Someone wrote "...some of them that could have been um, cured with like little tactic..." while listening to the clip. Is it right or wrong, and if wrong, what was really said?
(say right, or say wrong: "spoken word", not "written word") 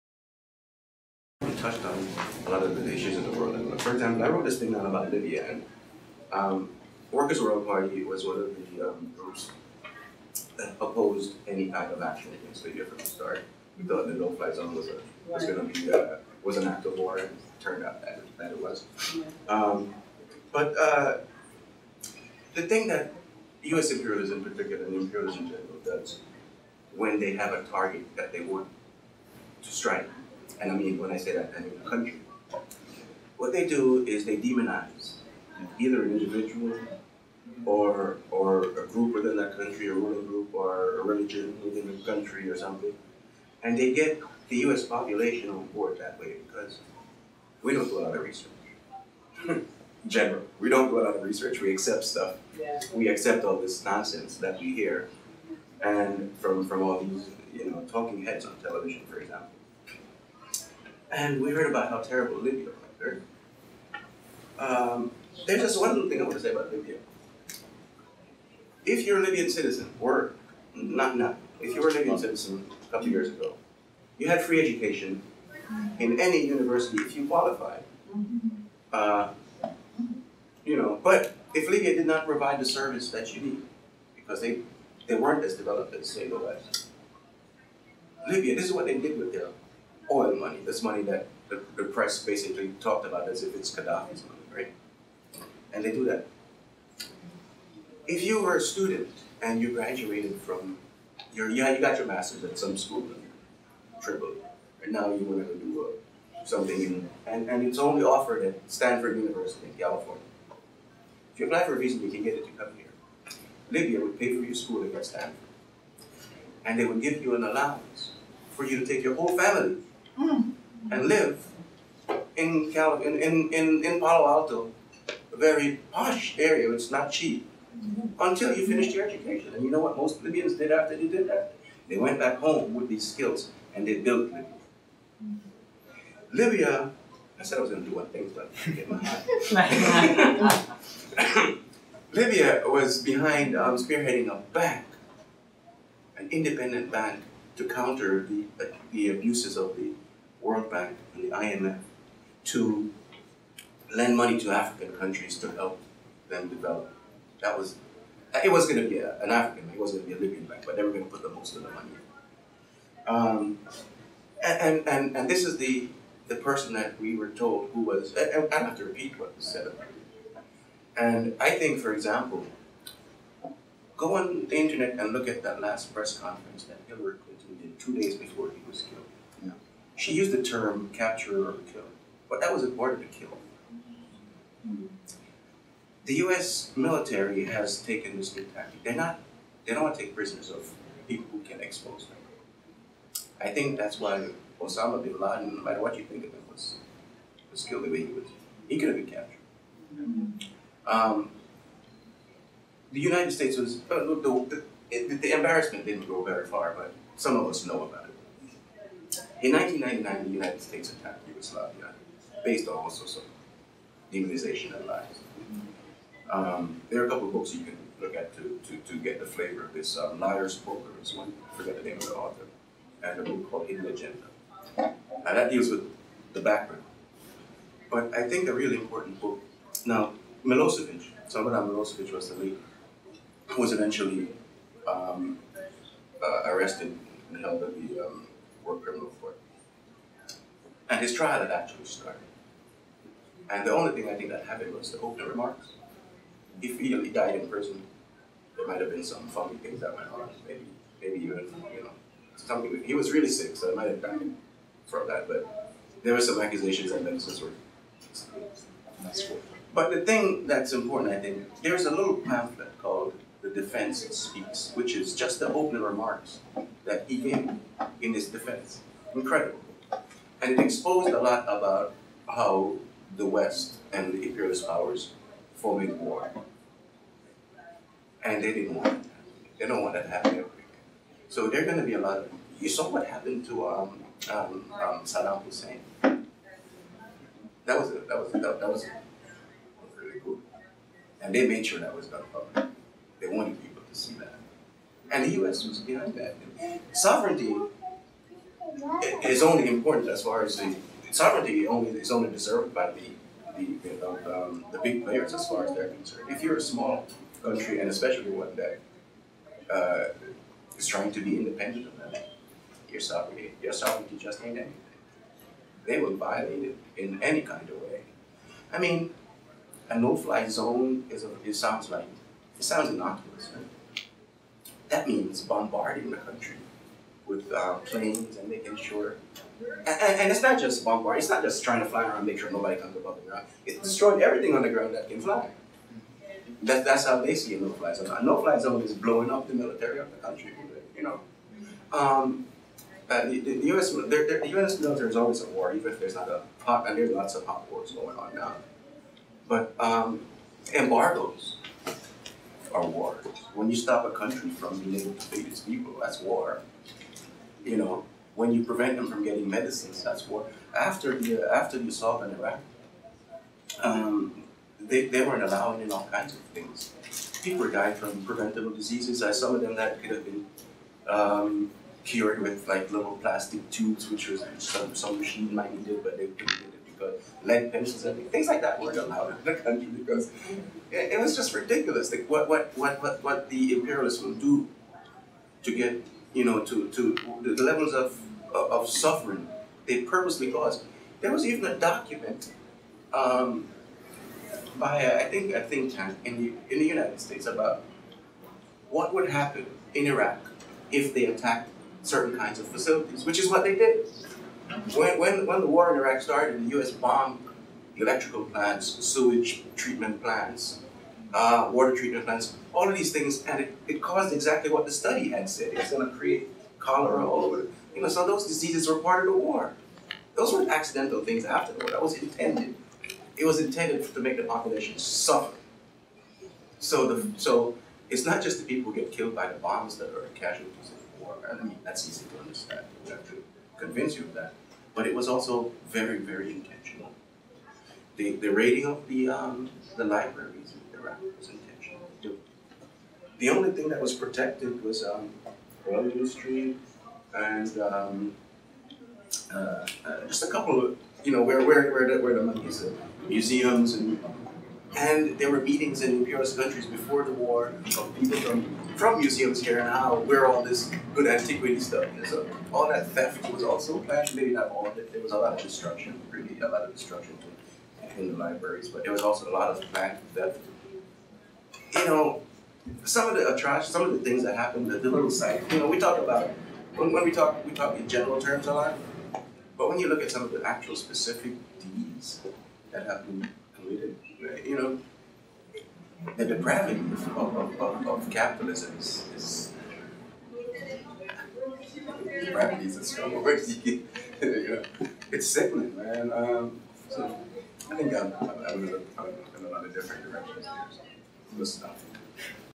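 wrong: "plastic", not "tactic".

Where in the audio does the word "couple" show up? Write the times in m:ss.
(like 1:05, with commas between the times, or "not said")
1:12, 3:37, 7:30.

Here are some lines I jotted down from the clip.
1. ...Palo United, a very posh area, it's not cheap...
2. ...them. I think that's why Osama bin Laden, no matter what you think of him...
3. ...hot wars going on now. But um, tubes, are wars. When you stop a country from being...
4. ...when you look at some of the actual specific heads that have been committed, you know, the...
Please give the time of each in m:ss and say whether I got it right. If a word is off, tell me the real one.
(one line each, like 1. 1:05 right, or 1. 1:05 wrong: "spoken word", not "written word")
1. 2:03 wrong: "Alto", not "United"
2. 3:12 right
3. 5:47 wrong: "embargoes", not "tubes"
4. 7:59 wrong: "deeds", not "heads".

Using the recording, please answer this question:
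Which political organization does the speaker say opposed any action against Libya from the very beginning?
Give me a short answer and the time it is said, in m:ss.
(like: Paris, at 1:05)
Workers' World Party, at 0:07.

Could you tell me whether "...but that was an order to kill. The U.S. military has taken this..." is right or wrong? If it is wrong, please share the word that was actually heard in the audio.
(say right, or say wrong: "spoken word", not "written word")
right.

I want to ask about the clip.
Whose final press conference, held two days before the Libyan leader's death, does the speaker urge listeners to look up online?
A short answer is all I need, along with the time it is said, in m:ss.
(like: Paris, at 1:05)
Hillary Clinton, at 2:56.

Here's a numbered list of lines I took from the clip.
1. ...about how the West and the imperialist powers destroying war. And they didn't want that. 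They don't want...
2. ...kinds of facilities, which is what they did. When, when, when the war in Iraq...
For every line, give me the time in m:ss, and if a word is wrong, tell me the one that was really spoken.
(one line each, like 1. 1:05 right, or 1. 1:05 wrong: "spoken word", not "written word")
1. 4:31 wrong: "forming", not "destroying"
2. 6:42 right.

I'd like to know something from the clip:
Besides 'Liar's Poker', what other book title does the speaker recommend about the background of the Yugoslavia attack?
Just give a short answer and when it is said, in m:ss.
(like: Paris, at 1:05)
Hidden Agenda, at 3:43.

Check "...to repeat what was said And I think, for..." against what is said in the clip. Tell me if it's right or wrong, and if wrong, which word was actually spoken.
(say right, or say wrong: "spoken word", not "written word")
right.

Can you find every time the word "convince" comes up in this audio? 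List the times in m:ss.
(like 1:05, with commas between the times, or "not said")
7:13.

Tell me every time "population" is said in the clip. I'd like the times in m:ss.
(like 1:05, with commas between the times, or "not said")
0:44, 7:04.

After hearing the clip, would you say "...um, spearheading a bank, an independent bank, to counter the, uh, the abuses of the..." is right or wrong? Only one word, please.
right.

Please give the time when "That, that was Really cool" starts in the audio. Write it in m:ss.
4:48.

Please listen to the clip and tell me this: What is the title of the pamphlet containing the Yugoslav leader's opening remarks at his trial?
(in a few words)
The Defense Speaks.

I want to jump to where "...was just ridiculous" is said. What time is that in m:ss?
6:21.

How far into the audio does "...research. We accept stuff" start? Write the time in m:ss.
0:51.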